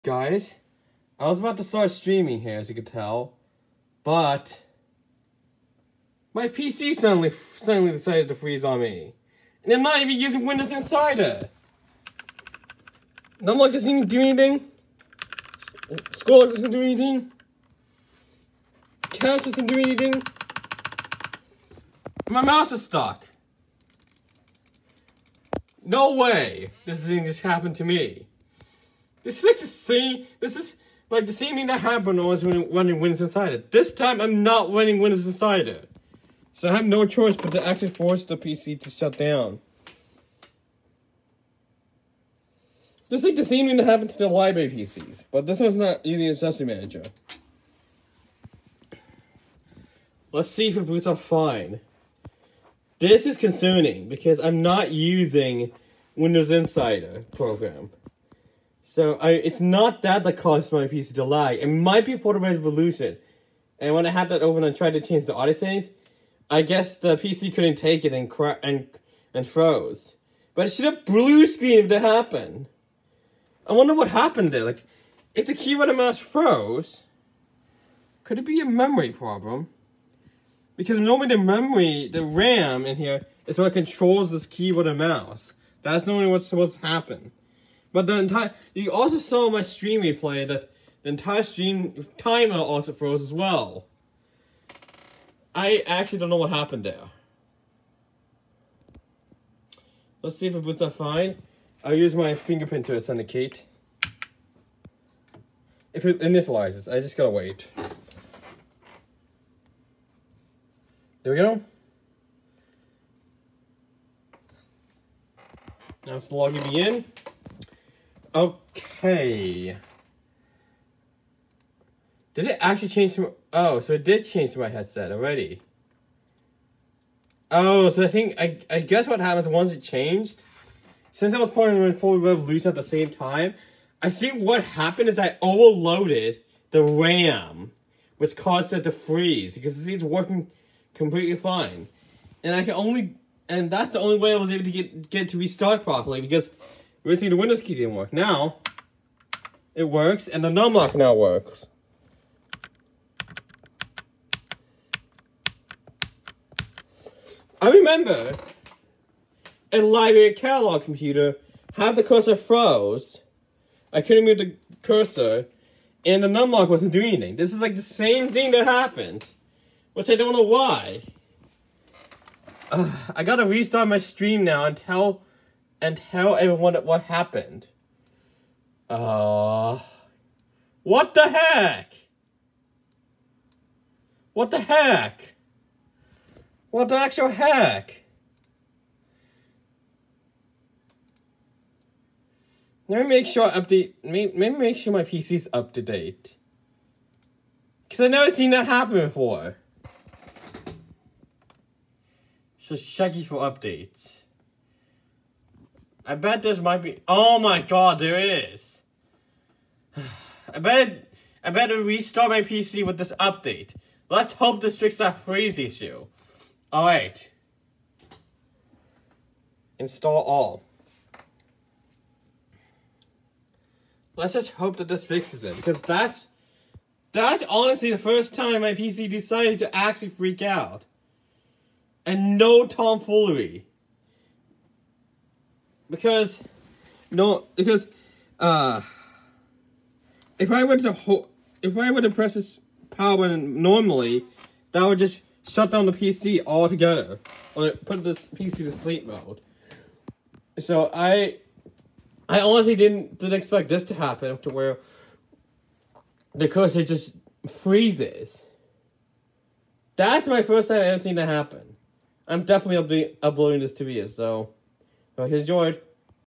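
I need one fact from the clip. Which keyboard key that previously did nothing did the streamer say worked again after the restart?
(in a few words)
Num lock.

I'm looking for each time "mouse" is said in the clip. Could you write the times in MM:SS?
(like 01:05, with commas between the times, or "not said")
00:22, 01:15, 01:24.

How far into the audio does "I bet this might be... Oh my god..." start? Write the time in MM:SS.
03:26.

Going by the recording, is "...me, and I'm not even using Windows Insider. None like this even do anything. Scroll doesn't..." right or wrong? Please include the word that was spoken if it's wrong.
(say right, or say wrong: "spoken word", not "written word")
right.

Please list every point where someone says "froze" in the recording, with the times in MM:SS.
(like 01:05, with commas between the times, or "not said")
01:09, 01:16, 01:32, 02:42.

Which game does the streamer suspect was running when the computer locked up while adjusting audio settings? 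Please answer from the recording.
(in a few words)
Portal Revolution.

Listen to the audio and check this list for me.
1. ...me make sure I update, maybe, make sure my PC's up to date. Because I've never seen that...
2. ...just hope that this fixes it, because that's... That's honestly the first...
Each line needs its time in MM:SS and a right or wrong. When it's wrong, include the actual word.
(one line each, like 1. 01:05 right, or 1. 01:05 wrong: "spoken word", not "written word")
1. 03:13 right
2. 03:44 right.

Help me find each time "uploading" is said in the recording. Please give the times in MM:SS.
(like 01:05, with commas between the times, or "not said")
04:23.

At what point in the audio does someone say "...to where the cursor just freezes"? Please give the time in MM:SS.
04:14.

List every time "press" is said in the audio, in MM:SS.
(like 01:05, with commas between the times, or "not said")
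04:02.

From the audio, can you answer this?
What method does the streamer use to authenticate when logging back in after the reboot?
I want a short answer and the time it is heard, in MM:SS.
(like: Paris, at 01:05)
Fingerprint, at 01:42.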